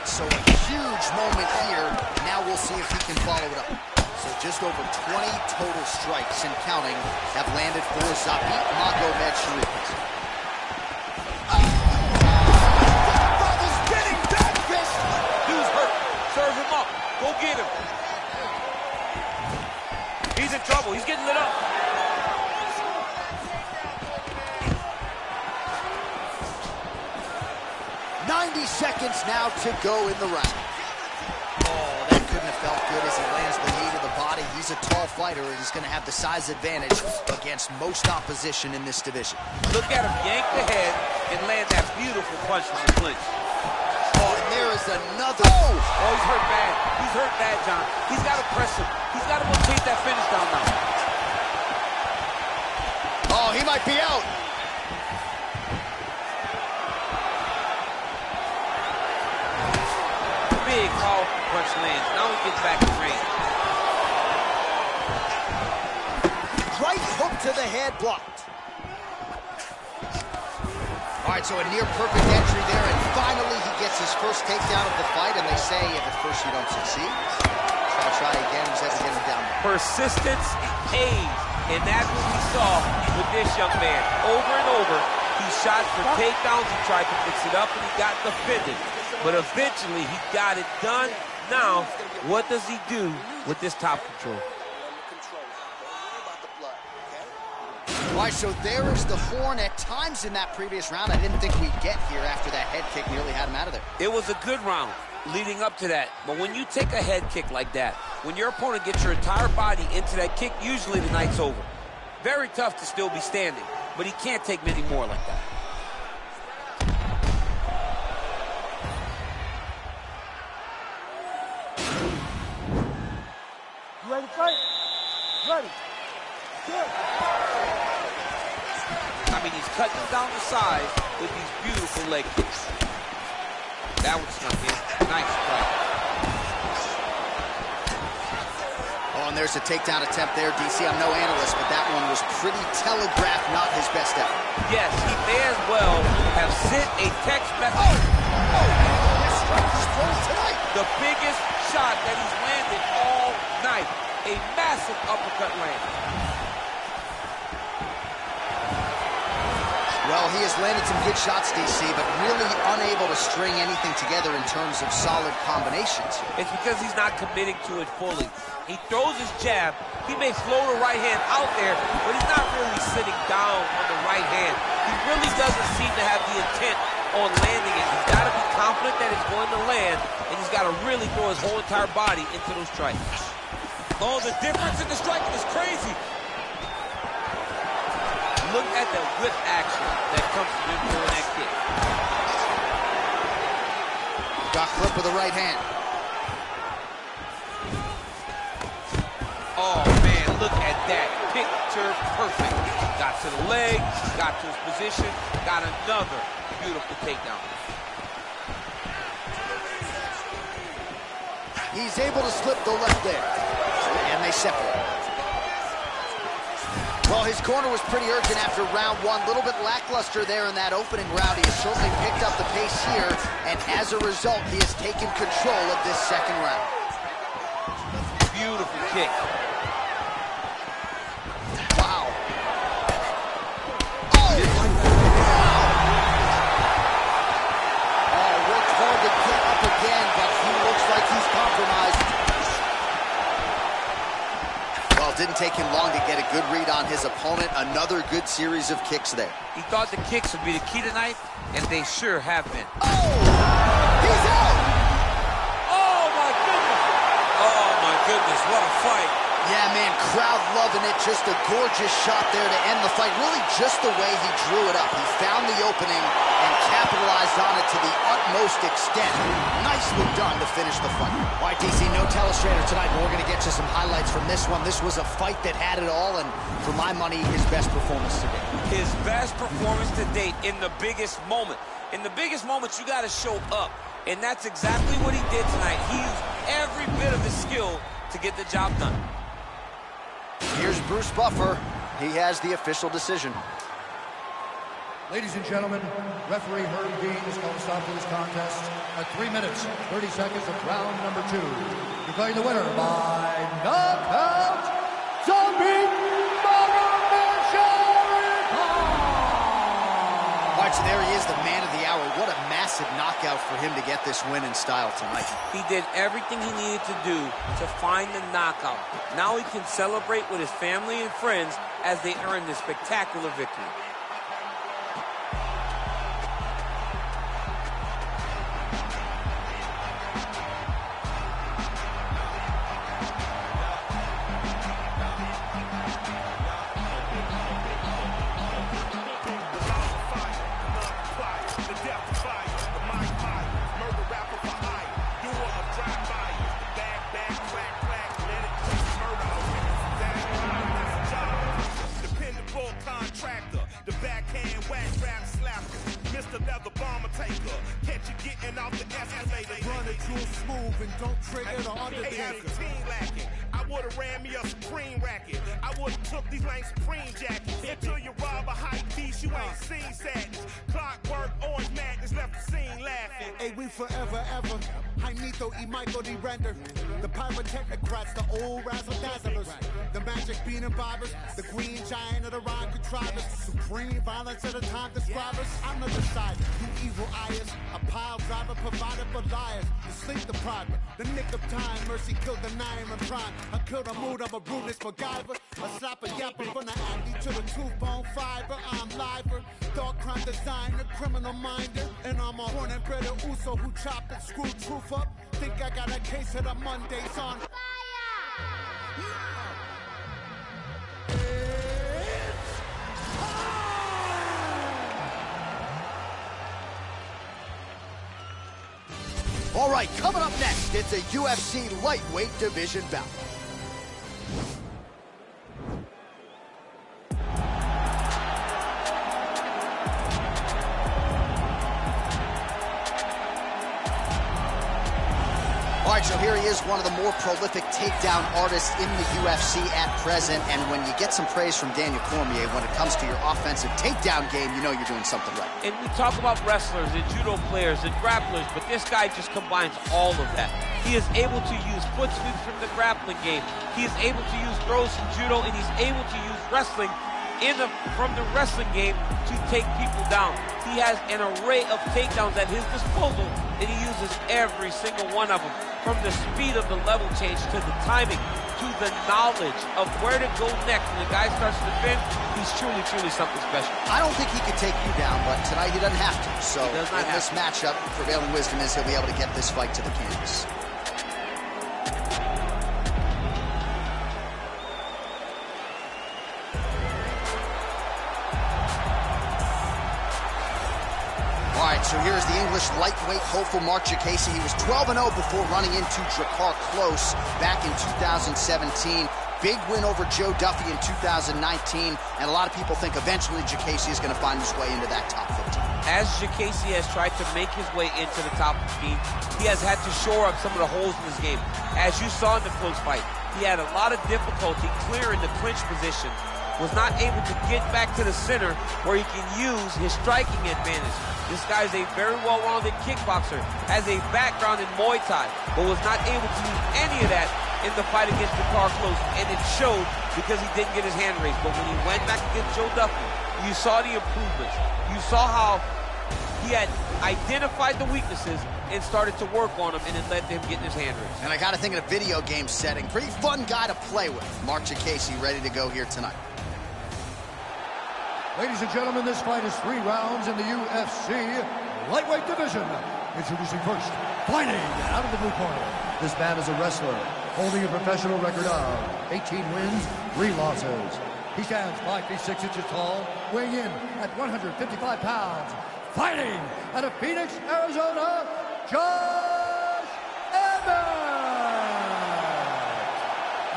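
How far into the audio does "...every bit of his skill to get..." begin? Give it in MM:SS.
04:46.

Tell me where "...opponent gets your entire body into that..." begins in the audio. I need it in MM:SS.
01:48.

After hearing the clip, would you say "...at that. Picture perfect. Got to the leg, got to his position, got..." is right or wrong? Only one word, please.
right.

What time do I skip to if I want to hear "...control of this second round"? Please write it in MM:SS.
03:45.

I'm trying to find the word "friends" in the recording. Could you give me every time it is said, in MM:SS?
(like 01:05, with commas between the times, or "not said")
05:21.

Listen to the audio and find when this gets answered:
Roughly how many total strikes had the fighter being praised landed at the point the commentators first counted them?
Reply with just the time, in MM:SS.
00:04.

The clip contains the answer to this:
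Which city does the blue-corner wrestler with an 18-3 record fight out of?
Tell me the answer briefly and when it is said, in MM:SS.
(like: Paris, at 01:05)
Phoenix, Arizona, at 09:26.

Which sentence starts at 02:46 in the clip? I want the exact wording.
It's because he's not committing to it fully.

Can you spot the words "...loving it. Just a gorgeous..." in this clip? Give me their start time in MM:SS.
04:20.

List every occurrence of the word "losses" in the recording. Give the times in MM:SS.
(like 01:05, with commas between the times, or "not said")
09:20.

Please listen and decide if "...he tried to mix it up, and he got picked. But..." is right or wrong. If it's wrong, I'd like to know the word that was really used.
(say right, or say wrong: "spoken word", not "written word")
wrong: "defended", not "picked".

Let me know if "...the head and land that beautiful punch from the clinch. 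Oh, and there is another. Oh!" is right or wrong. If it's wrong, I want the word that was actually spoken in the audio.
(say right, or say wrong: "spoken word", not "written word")
right.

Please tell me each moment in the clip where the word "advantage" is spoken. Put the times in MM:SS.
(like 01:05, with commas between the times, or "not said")
00:36, 08:40.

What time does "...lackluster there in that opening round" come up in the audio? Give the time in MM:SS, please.
03:39.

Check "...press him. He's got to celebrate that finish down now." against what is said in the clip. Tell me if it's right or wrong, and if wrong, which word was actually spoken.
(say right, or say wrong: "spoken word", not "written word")
wrong: "rotate", not "celebrate".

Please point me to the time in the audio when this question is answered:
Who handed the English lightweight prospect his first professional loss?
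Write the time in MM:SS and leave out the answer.
08:16.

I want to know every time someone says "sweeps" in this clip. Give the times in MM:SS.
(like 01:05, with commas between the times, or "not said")
07:32.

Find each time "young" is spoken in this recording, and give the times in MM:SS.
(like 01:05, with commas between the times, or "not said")
01:23.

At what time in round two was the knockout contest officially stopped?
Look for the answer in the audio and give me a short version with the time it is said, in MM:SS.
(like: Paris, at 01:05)
3 minutes, 30 seconds, at 04:59.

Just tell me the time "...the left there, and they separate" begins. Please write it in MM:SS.
03:32.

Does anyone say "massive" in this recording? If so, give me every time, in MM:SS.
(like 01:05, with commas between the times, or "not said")
02:34, 05:12.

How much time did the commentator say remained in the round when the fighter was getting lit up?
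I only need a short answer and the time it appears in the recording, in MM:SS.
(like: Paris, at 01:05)
90 seconds, at 00:28.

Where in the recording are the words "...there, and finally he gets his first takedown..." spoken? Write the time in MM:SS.
01:12.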